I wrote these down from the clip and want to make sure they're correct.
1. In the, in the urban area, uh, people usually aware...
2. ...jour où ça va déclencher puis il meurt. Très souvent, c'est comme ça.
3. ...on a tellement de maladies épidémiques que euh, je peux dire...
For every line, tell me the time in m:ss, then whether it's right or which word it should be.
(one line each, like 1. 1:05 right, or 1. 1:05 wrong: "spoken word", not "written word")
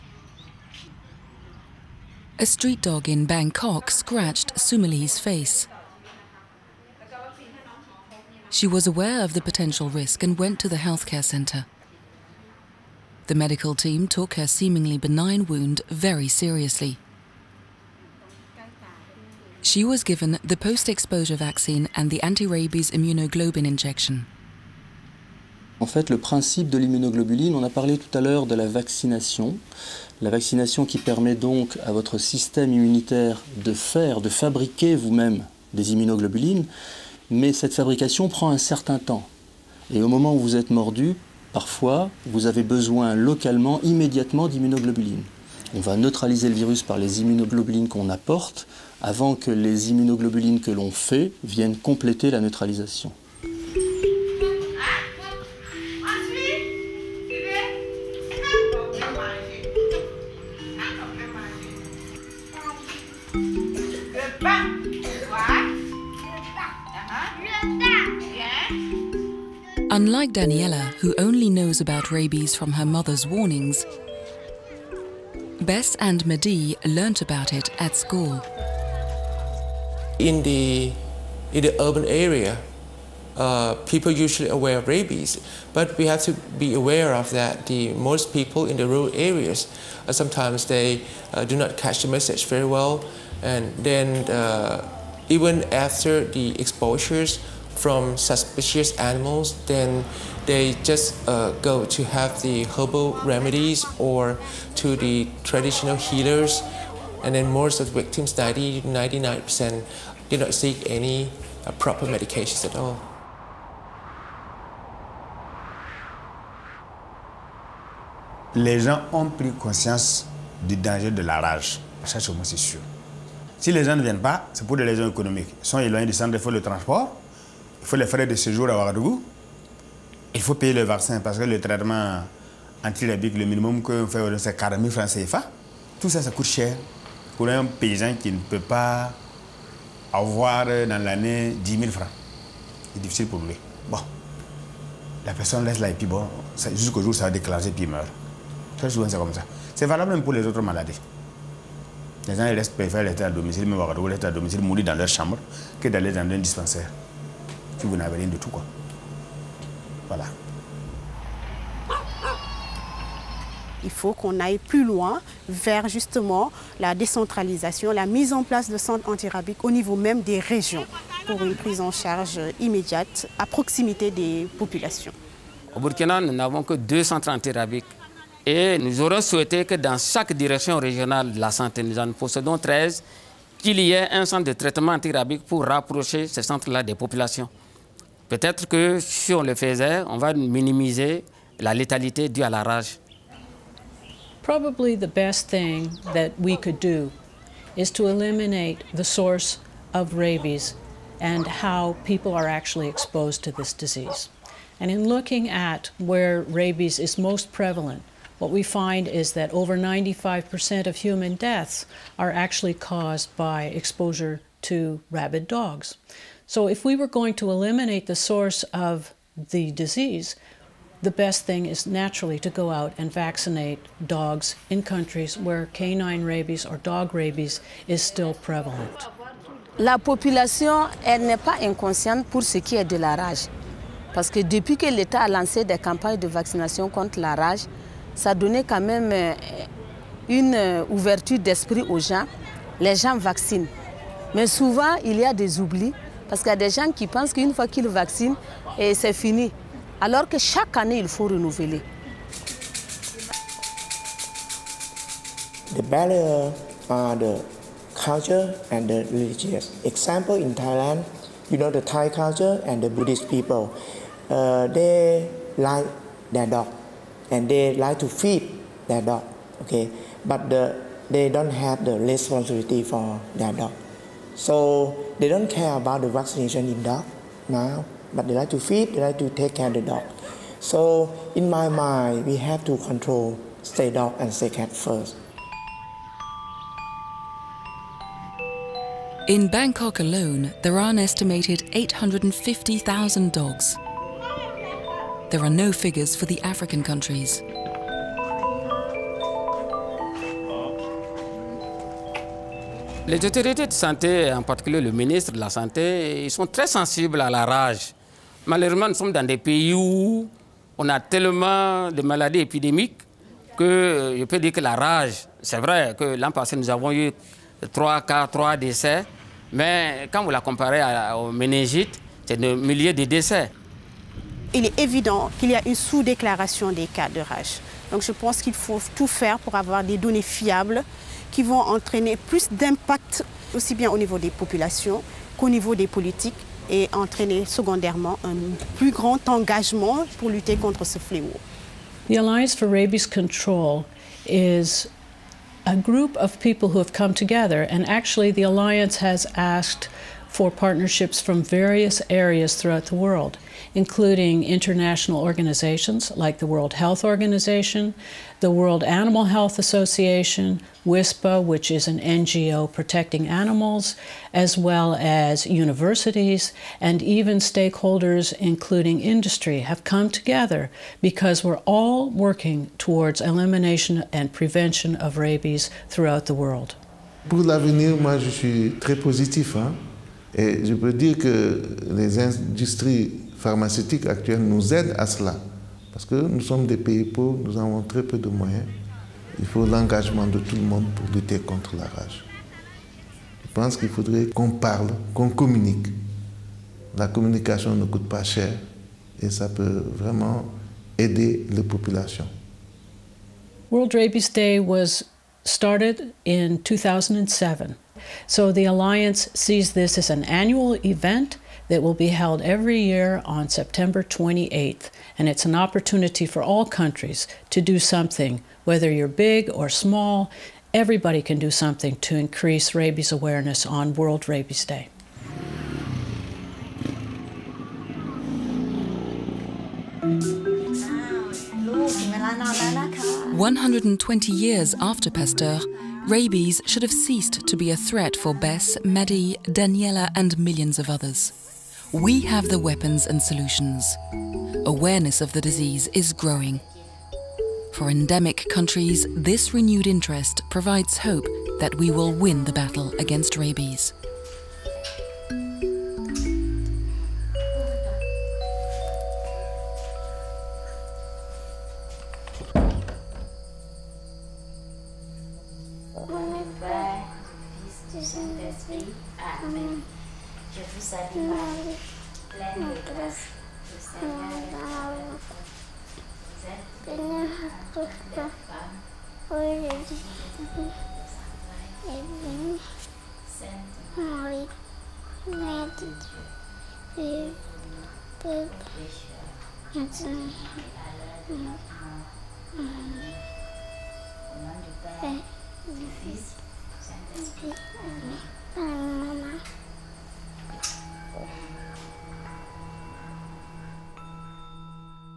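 1. 1:20 right
2. 2:26 right
3. 5:10 right.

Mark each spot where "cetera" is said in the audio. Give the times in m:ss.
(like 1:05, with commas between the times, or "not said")
not said.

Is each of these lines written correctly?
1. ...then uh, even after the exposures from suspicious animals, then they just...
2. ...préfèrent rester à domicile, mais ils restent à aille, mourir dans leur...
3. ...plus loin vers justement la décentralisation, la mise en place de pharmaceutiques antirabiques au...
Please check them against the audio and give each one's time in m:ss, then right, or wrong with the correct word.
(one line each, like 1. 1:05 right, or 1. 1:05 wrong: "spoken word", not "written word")
1. 1:33 right
2. 2:32 wrong: "domicile", not "aille"
3. 2:44 wrong: "centres", not "pharmaceutiques".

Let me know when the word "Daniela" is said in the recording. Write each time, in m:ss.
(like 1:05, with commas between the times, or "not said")
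1:10, 7:19.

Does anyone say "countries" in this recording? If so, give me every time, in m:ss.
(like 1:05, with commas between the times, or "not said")
3:44, 4:56, 6:56, 7:28.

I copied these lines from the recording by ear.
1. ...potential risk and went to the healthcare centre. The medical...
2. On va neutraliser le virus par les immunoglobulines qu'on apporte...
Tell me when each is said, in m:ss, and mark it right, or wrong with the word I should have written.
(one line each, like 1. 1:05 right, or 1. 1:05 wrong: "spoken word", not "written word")
1. 0:09 right
2. 0:45 right.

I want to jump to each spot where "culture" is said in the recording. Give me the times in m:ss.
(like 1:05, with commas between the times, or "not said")
4:17, 4:22.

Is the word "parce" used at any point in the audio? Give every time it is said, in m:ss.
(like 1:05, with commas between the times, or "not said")
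2:11, 3:54, 4:06, 6:25.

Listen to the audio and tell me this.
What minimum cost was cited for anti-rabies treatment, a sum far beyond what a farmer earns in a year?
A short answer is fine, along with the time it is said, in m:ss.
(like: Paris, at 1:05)
40,000 CFA francs, at 2:14.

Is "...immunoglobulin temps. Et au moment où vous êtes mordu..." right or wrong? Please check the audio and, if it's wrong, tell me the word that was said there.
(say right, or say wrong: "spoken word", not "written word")
wrong: "certain", not "immunoglobulin".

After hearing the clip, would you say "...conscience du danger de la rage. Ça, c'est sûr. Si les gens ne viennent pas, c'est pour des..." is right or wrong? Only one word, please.
right.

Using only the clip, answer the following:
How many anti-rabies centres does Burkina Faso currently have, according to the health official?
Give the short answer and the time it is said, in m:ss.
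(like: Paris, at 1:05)
2, at 2:56.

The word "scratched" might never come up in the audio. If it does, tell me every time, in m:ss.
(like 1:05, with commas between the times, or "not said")
0:03.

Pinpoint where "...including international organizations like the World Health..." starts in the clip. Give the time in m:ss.
5:53.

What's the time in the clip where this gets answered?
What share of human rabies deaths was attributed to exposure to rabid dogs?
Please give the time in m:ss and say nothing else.
3:29.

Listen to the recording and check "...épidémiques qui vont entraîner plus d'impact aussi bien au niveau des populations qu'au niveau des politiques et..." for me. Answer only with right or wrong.
wrong.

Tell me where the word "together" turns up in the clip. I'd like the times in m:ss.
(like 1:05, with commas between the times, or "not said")
5:47, 6:10.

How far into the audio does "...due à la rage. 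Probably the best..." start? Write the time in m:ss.
3:12.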